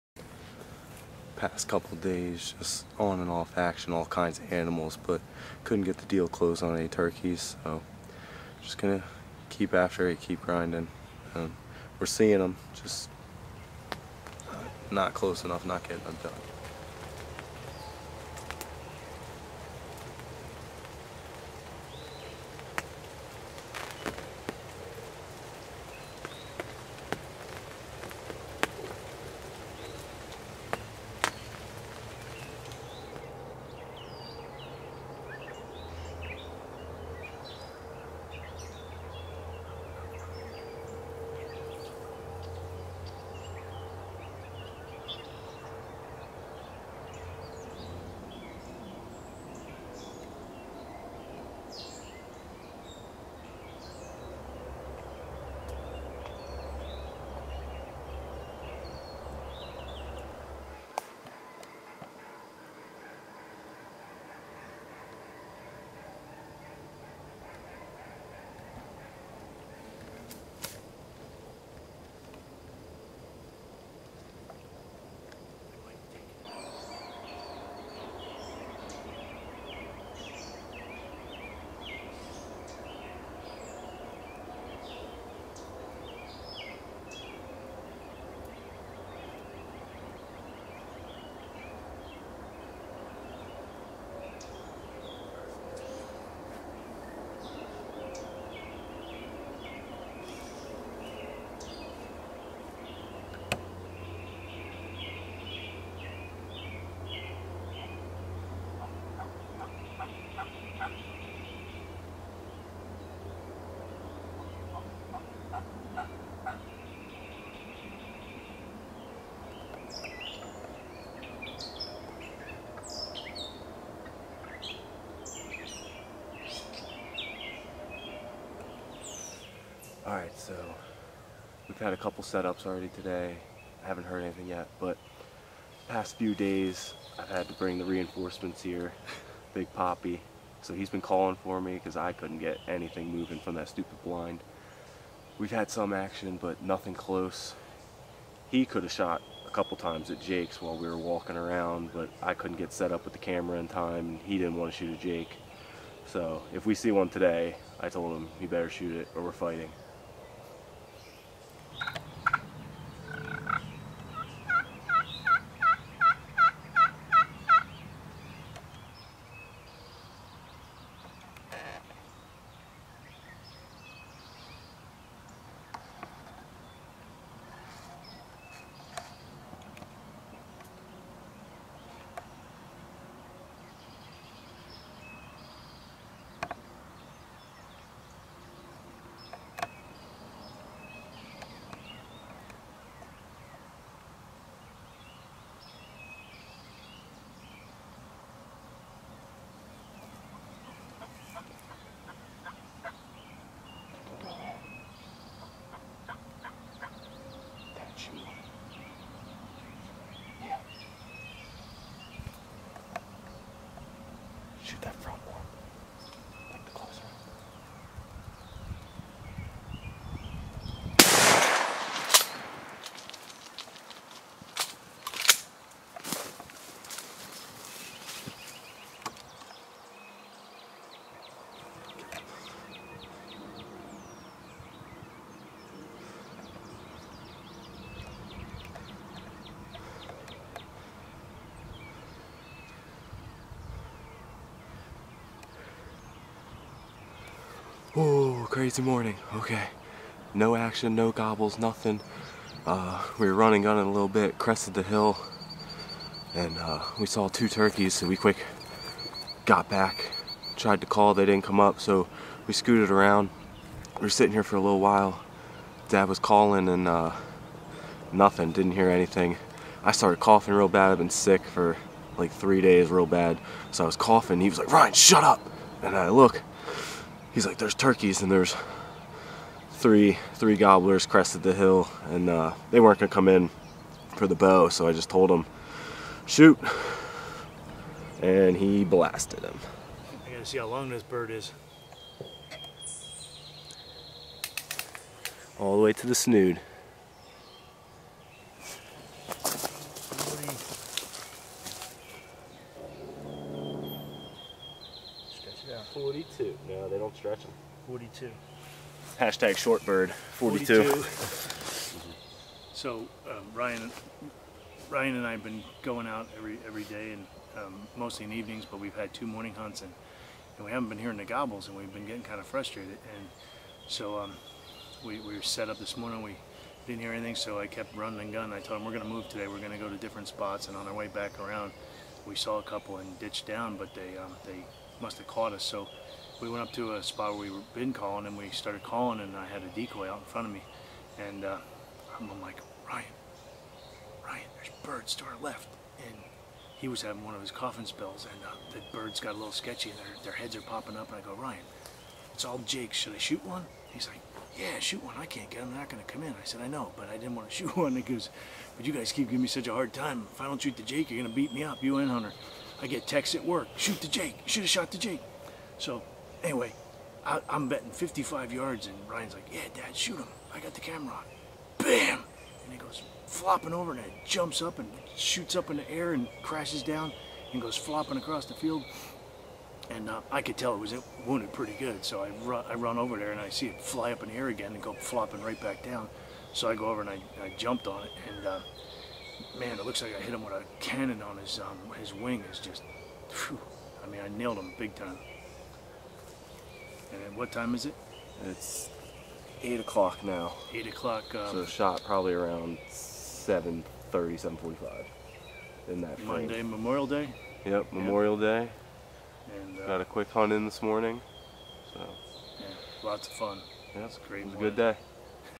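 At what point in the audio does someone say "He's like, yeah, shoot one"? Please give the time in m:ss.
5:53.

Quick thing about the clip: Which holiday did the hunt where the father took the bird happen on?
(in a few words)
Memorial Day.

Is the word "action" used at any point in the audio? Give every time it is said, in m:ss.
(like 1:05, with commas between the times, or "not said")
0:03, 2:25, 4:10.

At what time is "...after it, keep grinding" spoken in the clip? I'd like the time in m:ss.
0:09.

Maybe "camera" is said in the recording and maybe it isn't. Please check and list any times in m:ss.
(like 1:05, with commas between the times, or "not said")
2:33, 6:10.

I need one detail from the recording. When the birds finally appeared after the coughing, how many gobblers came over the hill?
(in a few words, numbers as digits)
3.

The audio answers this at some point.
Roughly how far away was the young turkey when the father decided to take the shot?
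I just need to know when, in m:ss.
6:07.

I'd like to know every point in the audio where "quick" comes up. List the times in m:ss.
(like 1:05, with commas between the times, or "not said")
4:18, 6:50.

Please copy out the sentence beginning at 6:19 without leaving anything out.
And uh, I could tell it was wounded pretty good.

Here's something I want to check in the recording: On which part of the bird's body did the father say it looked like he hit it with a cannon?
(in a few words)
wing.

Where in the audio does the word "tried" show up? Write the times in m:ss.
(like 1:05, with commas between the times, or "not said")
4:20.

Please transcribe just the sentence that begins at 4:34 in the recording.
He was like, Ryan, shut up.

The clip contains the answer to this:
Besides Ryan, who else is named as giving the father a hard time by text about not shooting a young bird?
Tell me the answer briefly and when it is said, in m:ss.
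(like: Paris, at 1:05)
Hunter, at 6:02.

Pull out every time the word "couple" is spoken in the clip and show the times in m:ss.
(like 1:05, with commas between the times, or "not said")
0:01, 2:11, 2:29, 5:32.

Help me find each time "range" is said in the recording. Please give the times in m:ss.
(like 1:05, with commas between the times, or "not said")
not said.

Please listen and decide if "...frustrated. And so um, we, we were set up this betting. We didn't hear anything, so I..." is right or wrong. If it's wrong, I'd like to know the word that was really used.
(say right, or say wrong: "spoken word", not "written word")
wrong: "morning", not "betting".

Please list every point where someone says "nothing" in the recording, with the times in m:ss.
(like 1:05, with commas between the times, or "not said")
2:26, 4:11, 4:28.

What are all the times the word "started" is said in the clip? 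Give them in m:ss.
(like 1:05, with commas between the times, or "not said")
4:29, 5:38.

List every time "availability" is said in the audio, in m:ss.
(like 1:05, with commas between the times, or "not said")
not said.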